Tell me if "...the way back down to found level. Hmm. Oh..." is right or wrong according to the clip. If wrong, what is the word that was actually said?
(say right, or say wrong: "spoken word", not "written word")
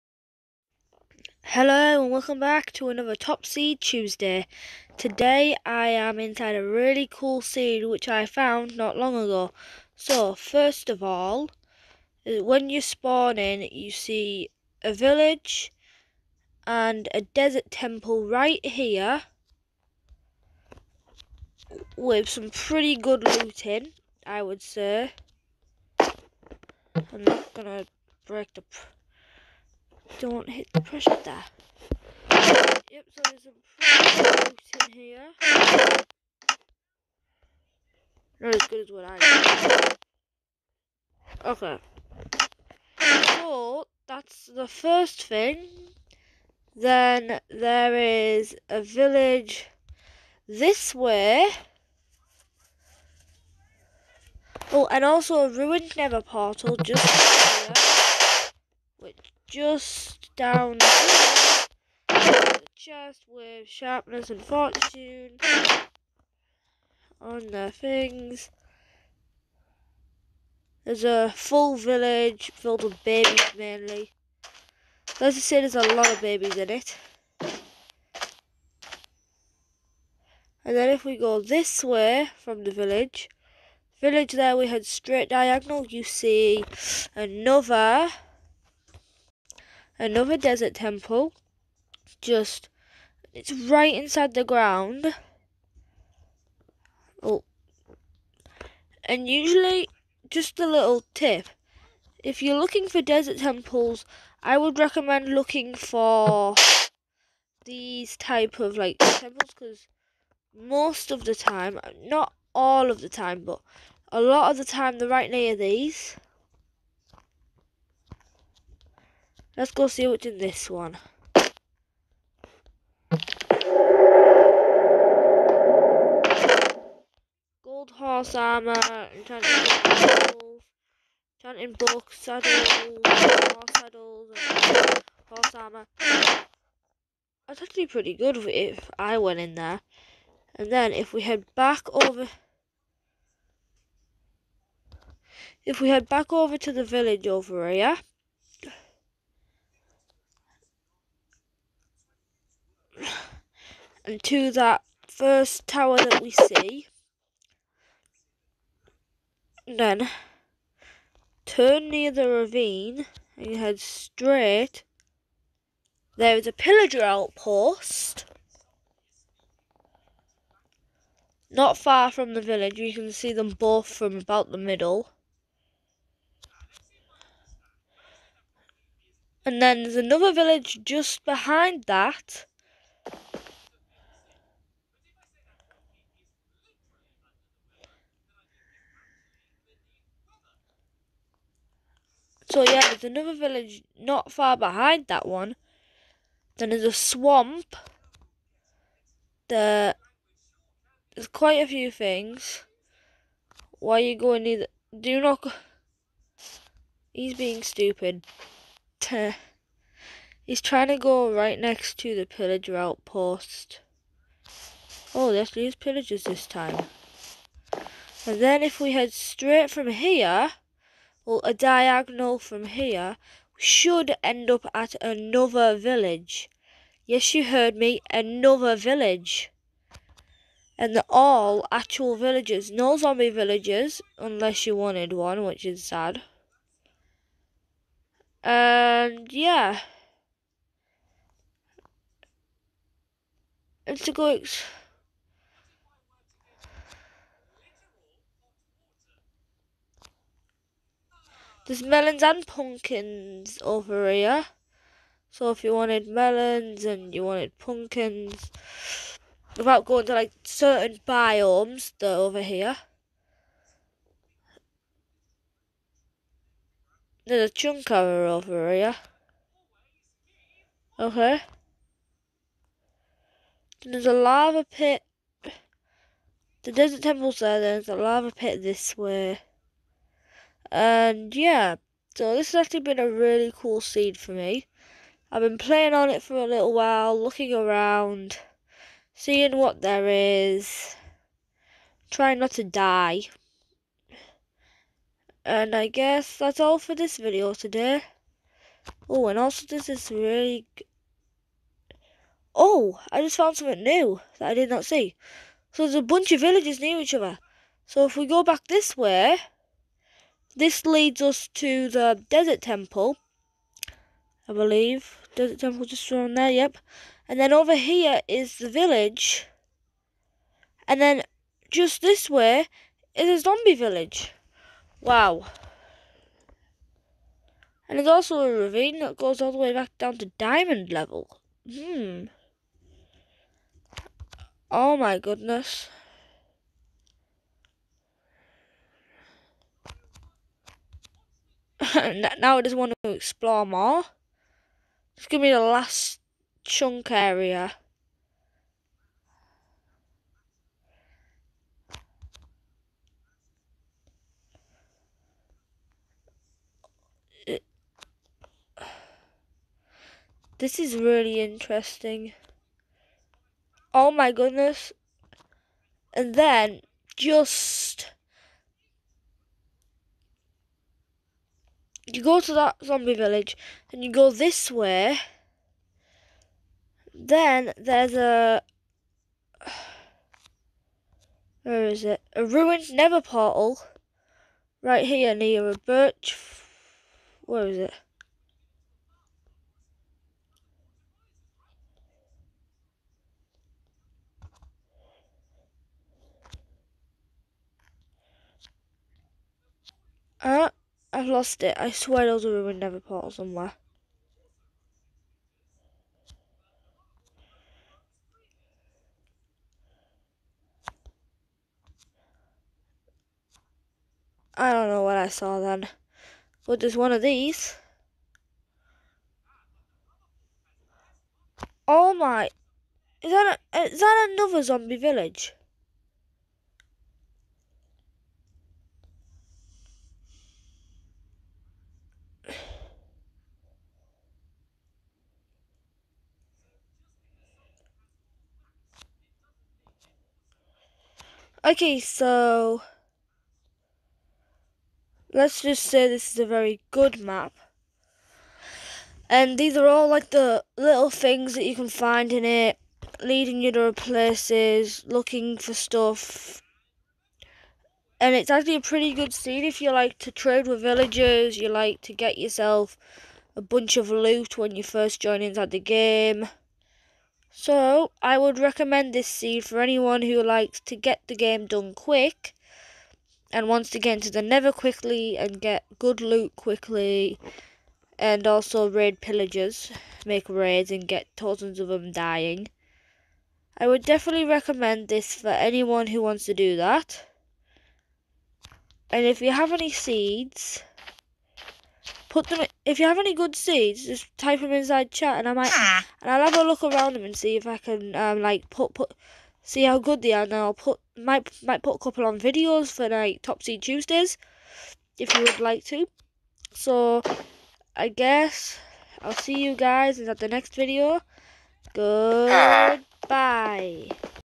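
wrong: "diamond", not "found".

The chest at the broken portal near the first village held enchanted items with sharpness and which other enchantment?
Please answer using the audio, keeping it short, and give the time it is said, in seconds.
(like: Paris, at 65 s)
fortune, at 64 s.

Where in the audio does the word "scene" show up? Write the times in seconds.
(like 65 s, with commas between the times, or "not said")
283 s, 459 s.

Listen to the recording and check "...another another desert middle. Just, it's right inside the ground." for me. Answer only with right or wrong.
wrong.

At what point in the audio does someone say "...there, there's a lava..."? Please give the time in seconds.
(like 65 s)
277 s.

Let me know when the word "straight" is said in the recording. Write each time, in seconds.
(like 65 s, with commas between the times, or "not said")
84 s, 163 s, 219 s.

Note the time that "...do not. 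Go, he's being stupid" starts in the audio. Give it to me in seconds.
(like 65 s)
204 s.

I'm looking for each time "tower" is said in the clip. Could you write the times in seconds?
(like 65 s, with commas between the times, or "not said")
155 s.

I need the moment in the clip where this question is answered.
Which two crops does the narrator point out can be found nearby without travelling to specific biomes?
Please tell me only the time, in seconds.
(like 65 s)
251 s.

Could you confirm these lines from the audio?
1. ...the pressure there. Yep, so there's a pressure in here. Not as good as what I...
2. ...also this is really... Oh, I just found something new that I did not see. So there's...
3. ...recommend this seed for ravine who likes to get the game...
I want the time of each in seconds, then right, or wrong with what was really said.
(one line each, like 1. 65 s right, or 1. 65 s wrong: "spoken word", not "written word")
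1. 30 s right
2. 299 s right
3. 468 s wrong: "anyone", not "ravine".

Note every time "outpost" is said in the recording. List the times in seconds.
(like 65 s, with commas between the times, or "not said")
167 s, 212 s.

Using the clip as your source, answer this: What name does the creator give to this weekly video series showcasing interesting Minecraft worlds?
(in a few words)
Top Seed Tuesday.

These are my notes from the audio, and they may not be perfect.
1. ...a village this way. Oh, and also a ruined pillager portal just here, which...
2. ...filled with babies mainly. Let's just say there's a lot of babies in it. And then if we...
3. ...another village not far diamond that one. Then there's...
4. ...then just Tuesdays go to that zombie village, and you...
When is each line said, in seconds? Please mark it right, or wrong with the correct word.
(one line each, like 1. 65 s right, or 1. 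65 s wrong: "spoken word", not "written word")
1. 48 s wrong: "nether", not "pillager"
2. 72 s right
3. 193 s wrong: "behind", not "diamond"
4. 366 s wrong: "You", not "Tuesdays".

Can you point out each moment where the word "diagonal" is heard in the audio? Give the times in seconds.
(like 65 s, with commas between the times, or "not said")
85 s, 221 s.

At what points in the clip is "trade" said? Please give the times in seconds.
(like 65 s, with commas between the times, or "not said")
460 s.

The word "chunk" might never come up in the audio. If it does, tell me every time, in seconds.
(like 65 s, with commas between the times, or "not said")
267 s, 346 s.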